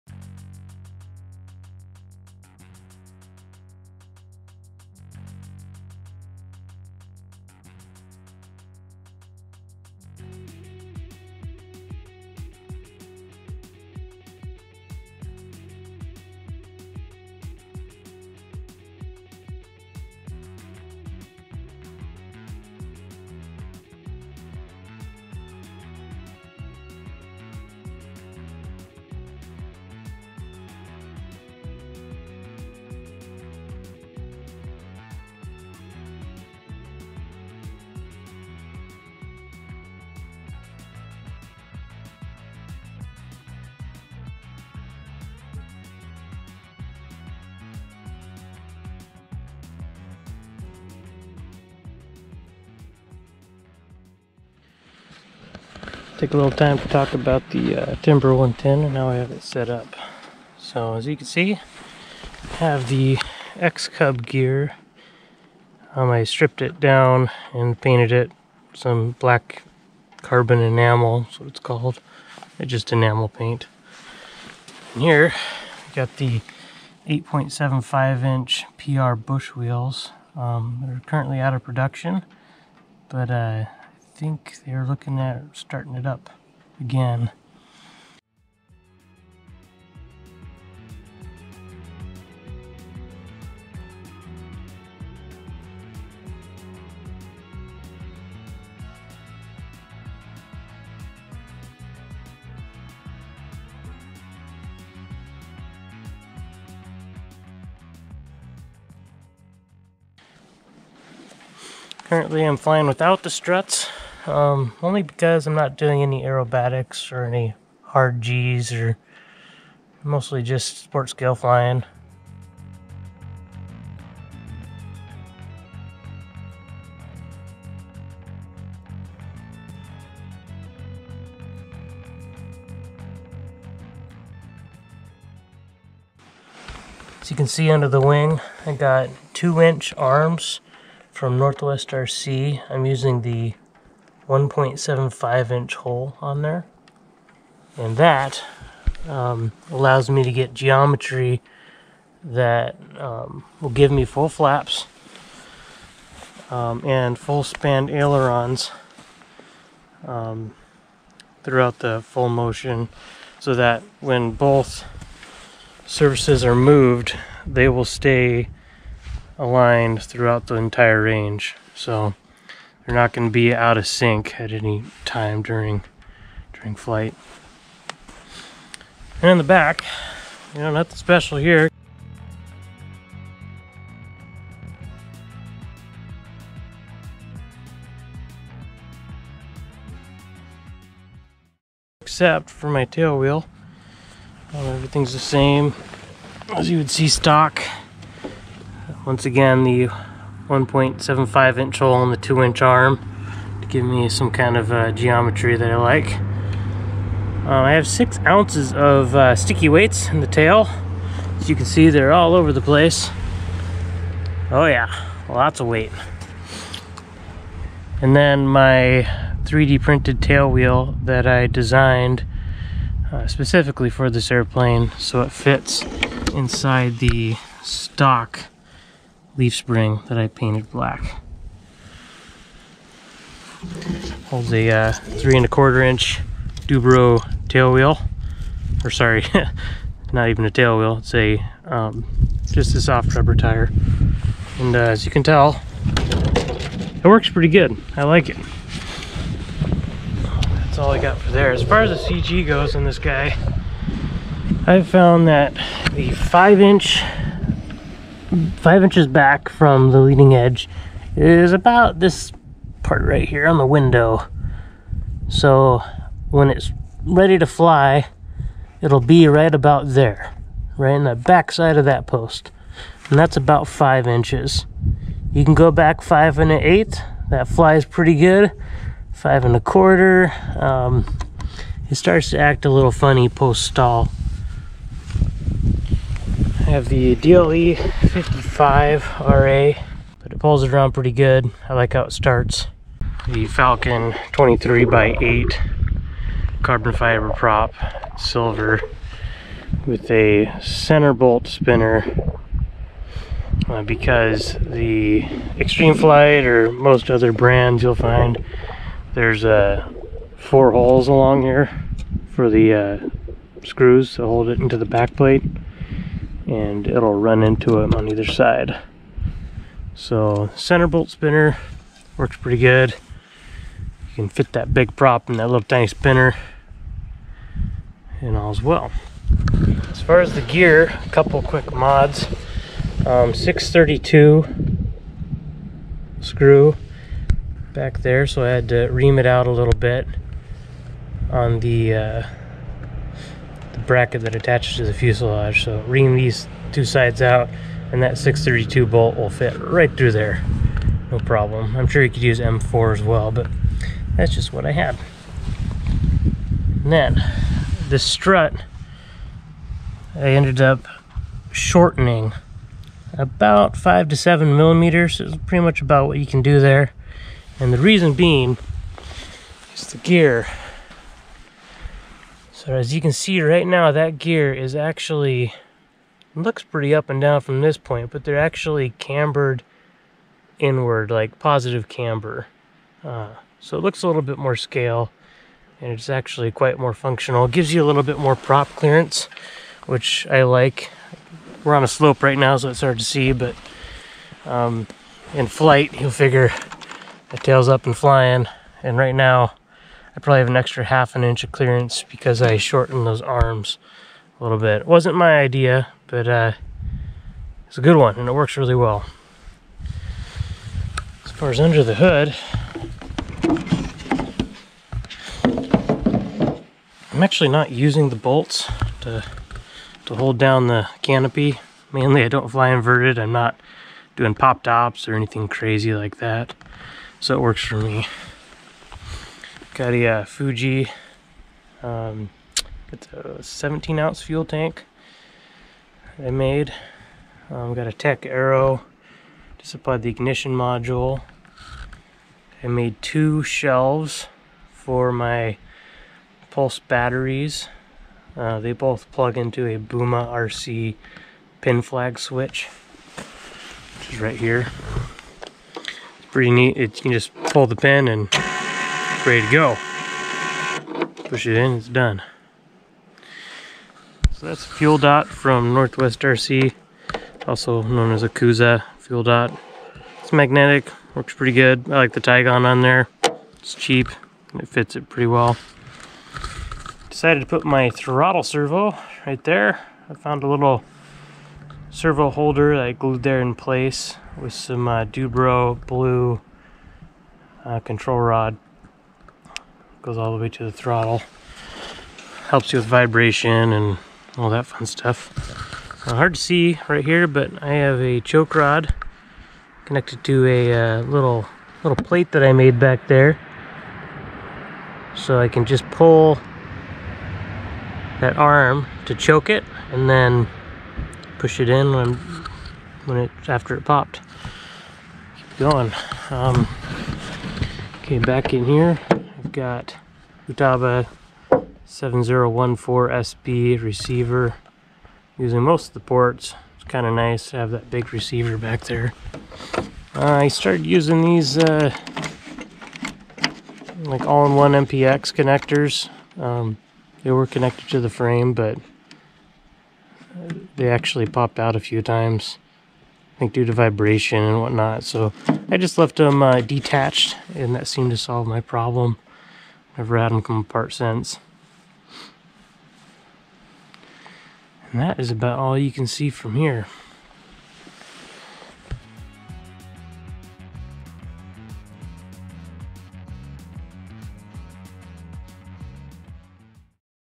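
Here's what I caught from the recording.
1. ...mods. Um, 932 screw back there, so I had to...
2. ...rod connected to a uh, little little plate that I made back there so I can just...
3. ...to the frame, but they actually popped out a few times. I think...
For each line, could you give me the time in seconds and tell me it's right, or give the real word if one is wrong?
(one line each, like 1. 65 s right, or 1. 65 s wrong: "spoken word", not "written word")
1. 331 s wrong: "632", not "932"
2. 498 s right
3. 537 s right.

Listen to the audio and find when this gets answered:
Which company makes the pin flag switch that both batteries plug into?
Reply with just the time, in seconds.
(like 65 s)
449 s.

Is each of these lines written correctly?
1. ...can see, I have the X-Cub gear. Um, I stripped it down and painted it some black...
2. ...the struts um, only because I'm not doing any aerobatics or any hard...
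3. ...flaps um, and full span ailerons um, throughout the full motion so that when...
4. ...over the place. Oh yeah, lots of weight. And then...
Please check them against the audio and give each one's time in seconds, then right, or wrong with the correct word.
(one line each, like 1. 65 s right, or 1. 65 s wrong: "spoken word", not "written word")
1. 61 s right
2. 113 s right
3. 154 s right
4. 212 s right.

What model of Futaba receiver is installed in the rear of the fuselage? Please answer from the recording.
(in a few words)
7014SB.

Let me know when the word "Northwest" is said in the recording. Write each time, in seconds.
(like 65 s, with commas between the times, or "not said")
141 s, 465 s.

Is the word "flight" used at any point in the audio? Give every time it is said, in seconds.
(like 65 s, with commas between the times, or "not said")
176 s, 305 s, 395 s.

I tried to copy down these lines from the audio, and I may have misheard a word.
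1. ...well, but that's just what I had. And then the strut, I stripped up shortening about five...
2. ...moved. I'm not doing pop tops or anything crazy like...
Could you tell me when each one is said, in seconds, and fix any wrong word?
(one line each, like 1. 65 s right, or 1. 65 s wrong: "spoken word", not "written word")
1. 353 s wrong: "ended", not "stripped"
2. 422 s wrong: "inverted", not "moved".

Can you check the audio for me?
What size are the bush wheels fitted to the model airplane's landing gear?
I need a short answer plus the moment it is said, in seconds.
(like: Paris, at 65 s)
8.75 inch, at 77 s.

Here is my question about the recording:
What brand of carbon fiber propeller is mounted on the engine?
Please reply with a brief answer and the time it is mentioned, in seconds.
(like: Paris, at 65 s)
Falcon, at 293 s.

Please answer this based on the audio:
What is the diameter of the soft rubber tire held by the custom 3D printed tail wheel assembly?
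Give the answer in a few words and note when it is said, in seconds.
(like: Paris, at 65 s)
3.25 inch, at 234 s.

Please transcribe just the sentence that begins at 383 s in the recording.
Uh, so it looks a little bit more scale, and it's actually quite more functional.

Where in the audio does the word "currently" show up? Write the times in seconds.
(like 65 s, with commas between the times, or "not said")
81 s, 112 s.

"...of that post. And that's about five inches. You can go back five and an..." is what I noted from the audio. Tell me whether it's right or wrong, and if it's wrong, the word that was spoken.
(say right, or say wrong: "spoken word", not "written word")
right.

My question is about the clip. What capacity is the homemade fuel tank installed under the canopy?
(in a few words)
17 ounce.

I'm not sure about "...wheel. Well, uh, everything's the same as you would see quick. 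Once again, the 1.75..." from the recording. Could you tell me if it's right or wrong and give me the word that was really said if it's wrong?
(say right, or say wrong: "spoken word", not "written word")
wrong: "stock", not "quick".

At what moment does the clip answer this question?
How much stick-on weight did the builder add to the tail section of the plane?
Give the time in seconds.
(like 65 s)
207 s.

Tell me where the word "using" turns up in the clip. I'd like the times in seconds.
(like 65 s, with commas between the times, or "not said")
142 s, 417 s, 525 s, 530 s.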